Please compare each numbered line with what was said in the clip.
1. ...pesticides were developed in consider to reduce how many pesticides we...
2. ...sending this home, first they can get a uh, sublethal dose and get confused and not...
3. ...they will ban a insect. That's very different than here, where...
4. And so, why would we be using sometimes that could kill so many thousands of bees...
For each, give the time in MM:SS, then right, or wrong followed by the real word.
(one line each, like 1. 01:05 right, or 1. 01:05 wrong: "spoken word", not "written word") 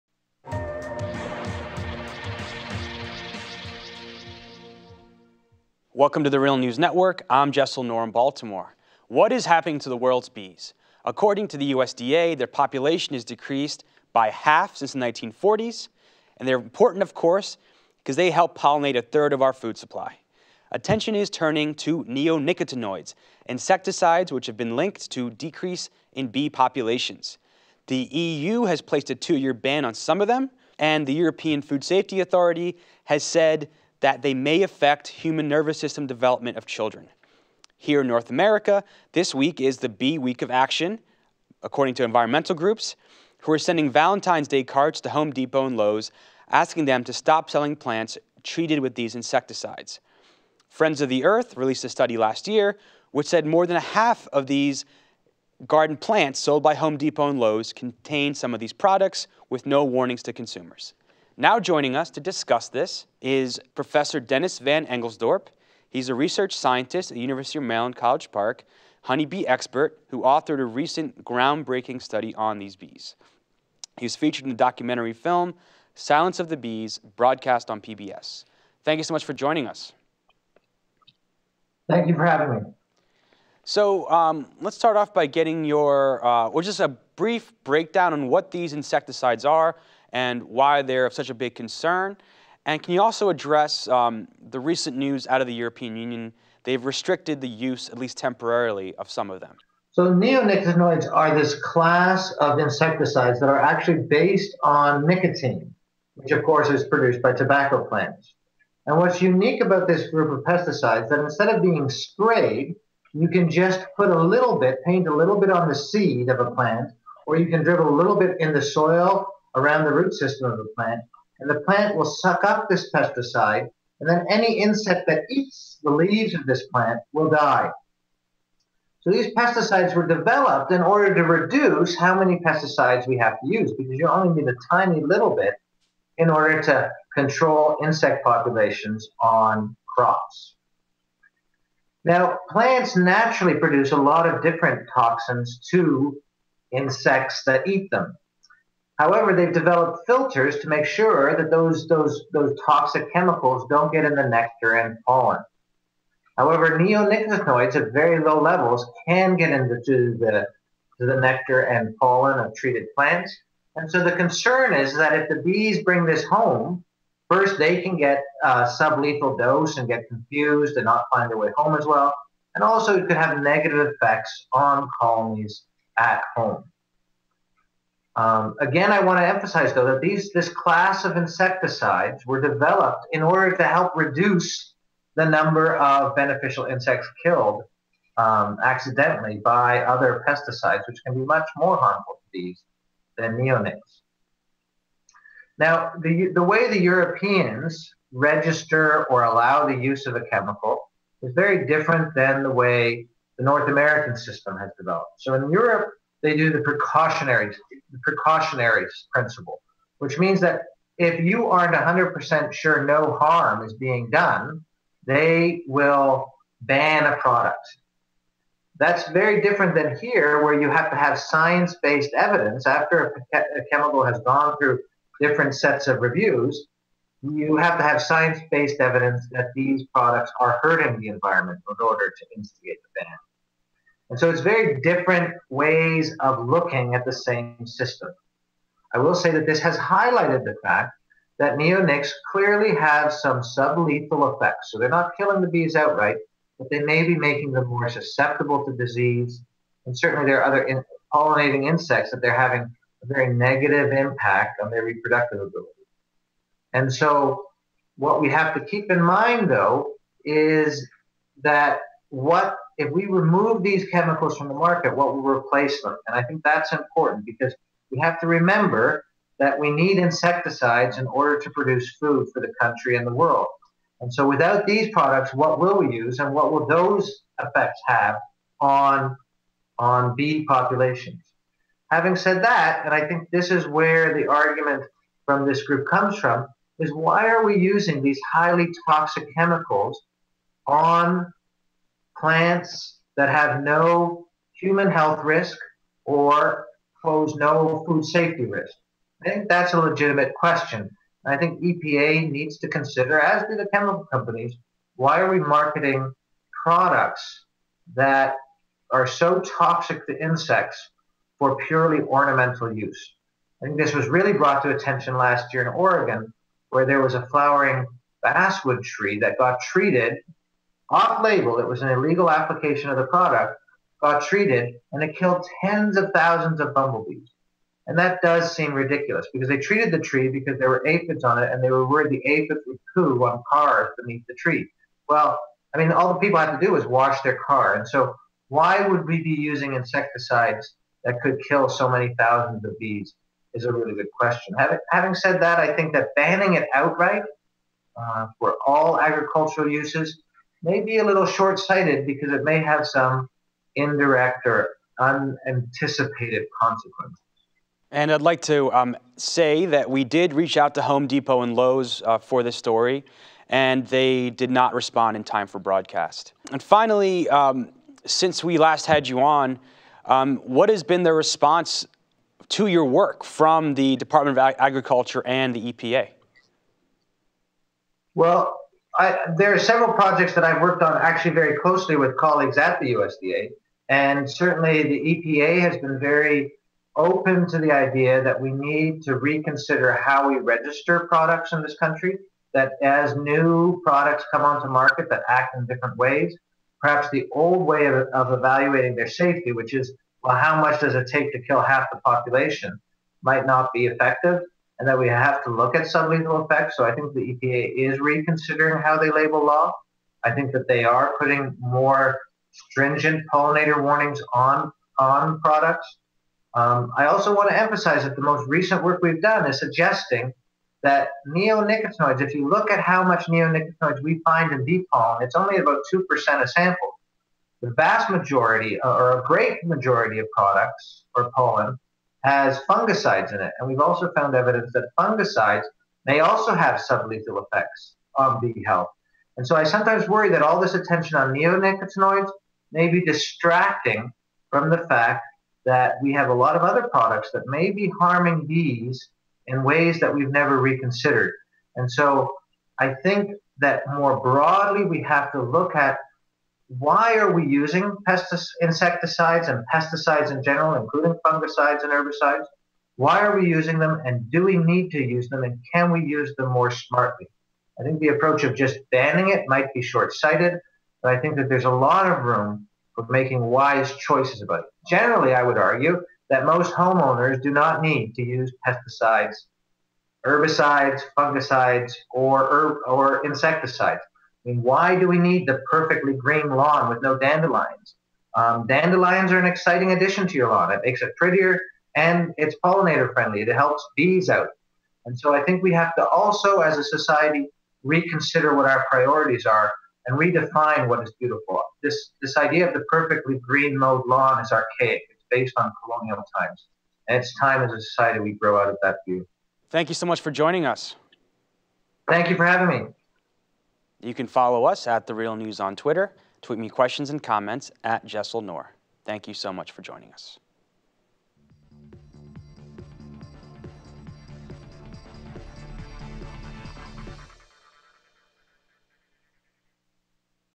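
1. 02:09 wrong: "order", not "consider"
2. 02:45 wrong: "bring", not "sending"
3. 03:35 wrong: "product", not "insect"
4. 05:37 wrong: "insecticides", not "sometimes".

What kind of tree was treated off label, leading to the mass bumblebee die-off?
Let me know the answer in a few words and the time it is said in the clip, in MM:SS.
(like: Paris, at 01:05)
basswood, at 05:18.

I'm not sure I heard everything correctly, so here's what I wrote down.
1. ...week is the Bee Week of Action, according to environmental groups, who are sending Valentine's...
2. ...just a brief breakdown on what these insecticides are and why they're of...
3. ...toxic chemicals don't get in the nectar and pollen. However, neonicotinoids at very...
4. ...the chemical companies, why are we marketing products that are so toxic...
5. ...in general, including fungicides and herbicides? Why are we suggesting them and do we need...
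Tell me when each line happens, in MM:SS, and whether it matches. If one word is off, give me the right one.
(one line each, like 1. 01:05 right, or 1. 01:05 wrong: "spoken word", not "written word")
1. 00:39 right
2. 01:26 right
3. 02:32 right
4. 05:03 right
5. 07:40 wrong: "using", not "suggesting".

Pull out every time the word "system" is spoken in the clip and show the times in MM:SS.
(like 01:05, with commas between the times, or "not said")
00:35, 02:00, 03:24, 03:57.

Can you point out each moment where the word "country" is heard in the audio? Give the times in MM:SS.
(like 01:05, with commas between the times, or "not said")
04:32, 06:31.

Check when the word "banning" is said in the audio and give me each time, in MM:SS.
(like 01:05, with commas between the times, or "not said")
05:46, 07:48.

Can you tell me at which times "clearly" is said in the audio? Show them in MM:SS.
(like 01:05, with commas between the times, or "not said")
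04:02.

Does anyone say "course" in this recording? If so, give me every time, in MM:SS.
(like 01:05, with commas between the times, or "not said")
00:17, 01:46.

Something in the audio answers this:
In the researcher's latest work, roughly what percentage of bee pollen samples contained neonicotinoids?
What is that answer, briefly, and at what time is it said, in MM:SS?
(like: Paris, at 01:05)
2%, at 07:05.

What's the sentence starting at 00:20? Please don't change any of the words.
Attention is turning to neonicotinoids, insecticides which have been linked to decrease in bee populations.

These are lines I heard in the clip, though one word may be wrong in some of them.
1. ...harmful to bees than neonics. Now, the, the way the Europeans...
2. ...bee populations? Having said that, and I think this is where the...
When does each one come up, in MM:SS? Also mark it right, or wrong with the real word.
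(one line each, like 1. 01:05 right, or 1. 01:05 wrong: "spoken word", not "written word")
1. 03:11 right
2. 04:40 right.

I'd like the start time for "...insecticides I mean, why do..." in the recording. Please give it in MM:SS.
08:03.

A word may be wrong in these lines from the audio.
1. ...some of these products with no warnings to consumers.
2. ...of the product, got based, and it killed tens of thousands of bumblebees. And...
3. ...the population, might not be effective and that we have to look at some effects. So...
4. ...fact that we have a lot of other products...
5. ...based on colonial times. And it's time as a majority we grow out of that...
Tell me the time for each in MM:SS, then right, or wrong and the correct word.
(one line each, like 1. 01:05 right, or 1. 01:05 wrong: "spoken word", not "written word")
1. 00:58 right
2. 05:22 wrong: "treated", not "based"
3. 06:41 right
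4. 07:24 right
5. 08:25 wrong: "society", not "majority".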